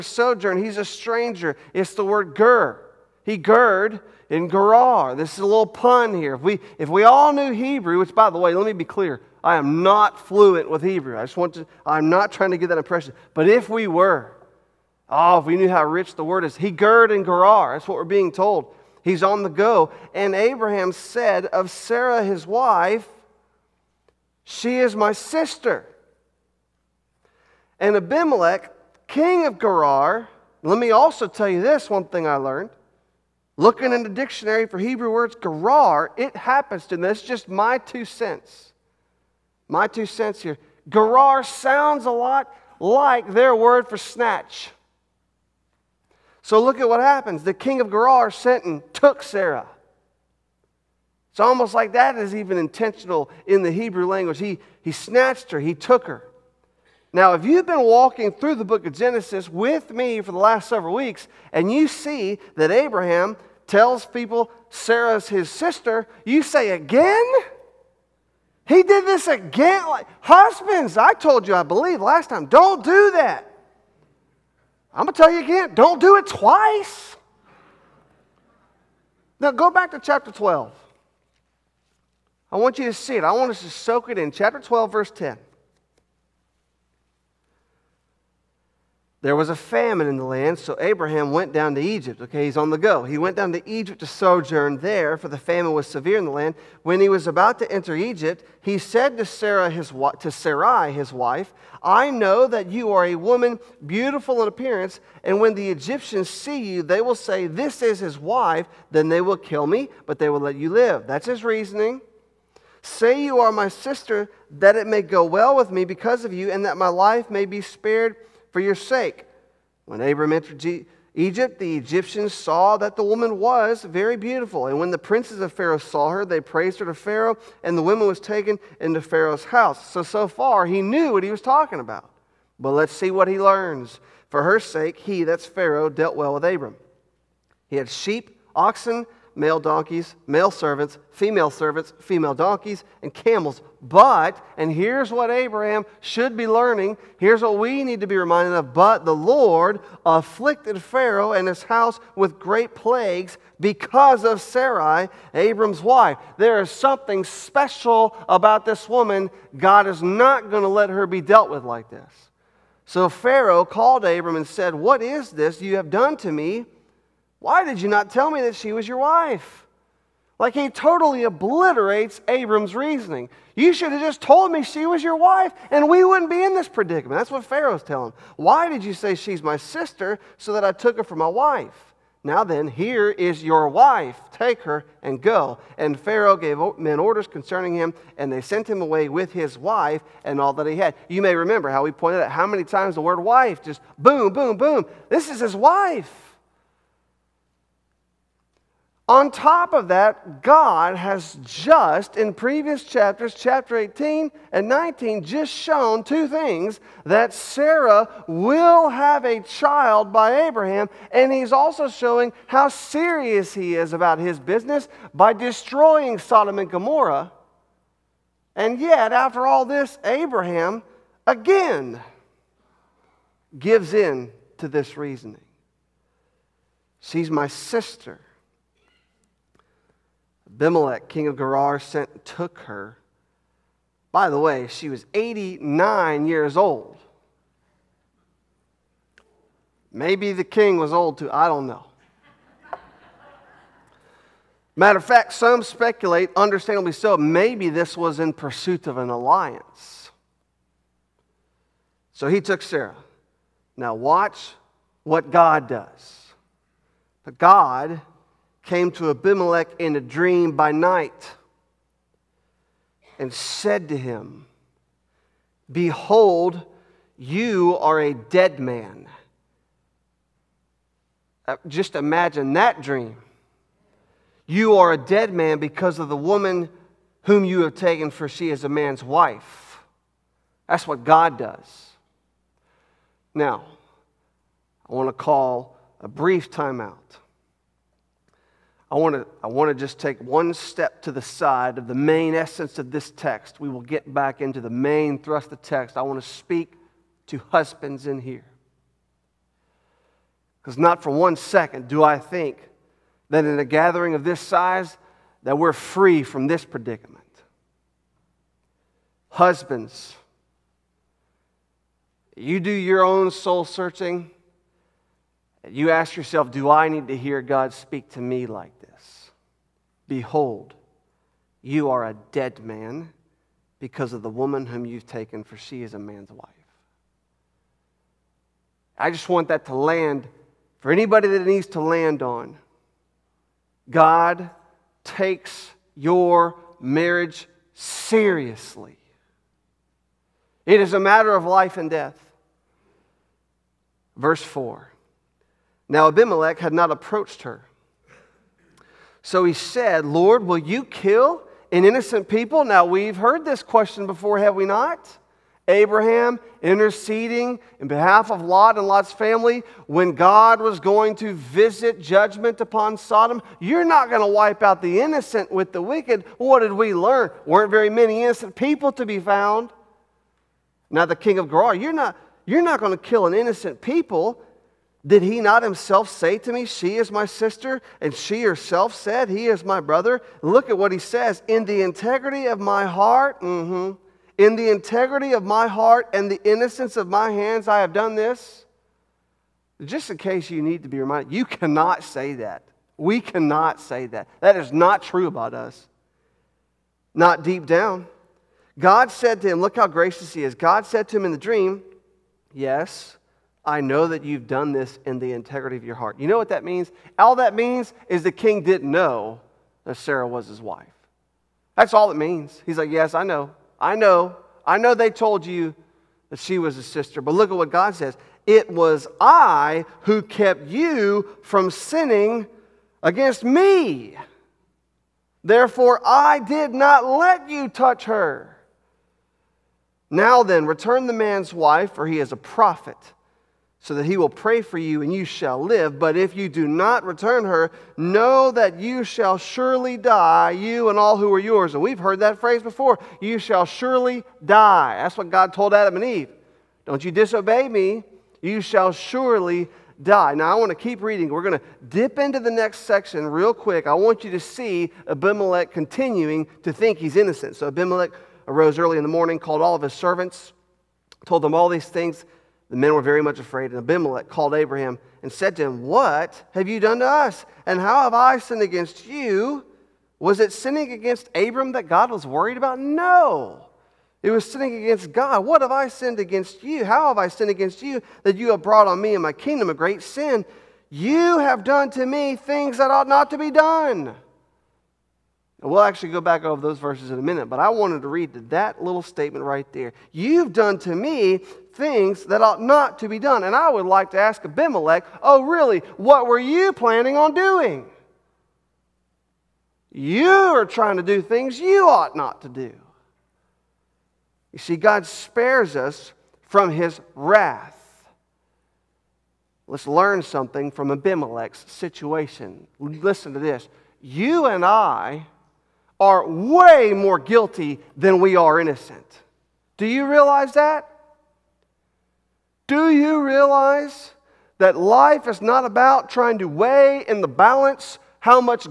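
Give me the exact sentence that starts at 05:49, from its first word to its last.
So he said, Lord, will you kill an innocent people?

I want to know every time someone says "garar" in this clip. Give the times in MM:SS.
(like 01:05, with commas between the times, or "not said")
00:35, 00:40.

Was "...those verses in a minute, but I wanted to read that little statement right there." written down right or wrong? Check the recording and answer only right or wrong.
right.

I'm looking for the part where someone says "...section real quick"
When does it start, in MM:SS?
07:32.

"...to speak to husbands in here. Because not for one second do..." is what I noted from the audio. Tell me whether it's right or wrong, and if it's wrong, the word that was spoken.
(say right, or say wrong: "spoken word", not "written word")
right.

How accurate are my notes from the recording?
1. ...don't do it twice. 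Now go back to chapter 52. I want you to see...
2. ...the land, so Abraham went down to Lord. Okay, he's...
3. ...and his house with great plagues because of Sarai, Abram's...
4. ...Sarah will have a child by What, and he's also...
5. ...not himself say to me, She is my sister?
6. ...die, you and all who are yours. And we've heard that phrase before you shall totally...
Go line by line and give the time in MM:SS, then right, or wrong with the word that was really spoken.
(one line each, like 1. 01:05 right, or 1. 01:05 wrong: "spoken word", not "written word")
1. 01:15 wrong: "12", not "52"
2. 01:30 wrong: "Egypt", not "Lord"
3. 02:31 right
4. 03:27 wrong: "Abraham", not "What"
5. 06:15 right
6. 07:19 wrong: "surely", not "totally".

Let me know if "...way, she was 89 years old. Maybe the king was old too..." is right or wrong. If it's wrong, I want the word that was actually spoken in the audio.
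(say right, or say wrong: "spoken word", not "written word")
right.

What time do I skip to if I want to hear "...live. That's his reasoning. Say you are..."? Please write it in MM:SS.
01:50.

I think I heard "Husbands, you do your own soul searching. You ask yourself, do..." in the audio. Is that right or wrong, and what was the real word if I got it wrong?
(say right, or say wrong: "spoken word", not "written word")
right.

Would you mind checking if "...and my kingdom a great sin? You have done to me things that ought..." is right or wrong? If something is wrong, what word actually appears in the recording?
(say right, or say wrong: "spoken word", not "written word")
right.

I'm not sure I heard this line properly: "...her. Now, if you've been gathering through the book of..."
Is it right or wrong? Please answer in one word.
wrong.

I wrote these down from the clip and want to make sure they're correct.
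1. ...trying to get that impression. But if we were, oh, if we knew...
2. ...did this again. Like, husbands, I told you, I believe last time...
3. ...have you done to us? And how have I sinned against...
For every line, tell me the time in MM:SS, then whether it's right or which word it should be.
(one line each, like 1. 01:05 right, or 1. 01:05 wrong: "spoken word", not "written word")
1. 00:12 right
2. 01:08 right
3. 07:46 right.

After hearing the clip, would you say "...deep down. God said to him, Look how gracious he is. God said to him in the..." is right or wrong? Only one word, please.
right.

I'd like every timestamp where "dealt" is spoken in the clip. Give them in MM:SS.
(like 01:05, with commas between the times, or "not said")
02:15, 02:41.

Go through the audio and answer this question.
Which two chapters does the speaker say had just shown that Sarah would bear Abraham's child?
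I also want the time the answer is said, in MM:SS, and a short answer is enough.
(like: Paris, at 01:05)
18 and 19, at 03:23.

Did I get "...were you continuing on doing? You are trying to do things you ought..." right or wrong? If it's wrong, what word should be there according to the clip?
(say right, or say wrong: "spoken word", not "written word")
wrong: "planning", not "continuing".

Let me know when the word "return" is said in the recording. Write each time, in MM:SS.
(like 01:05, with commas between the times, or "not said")
07:10, 07:17.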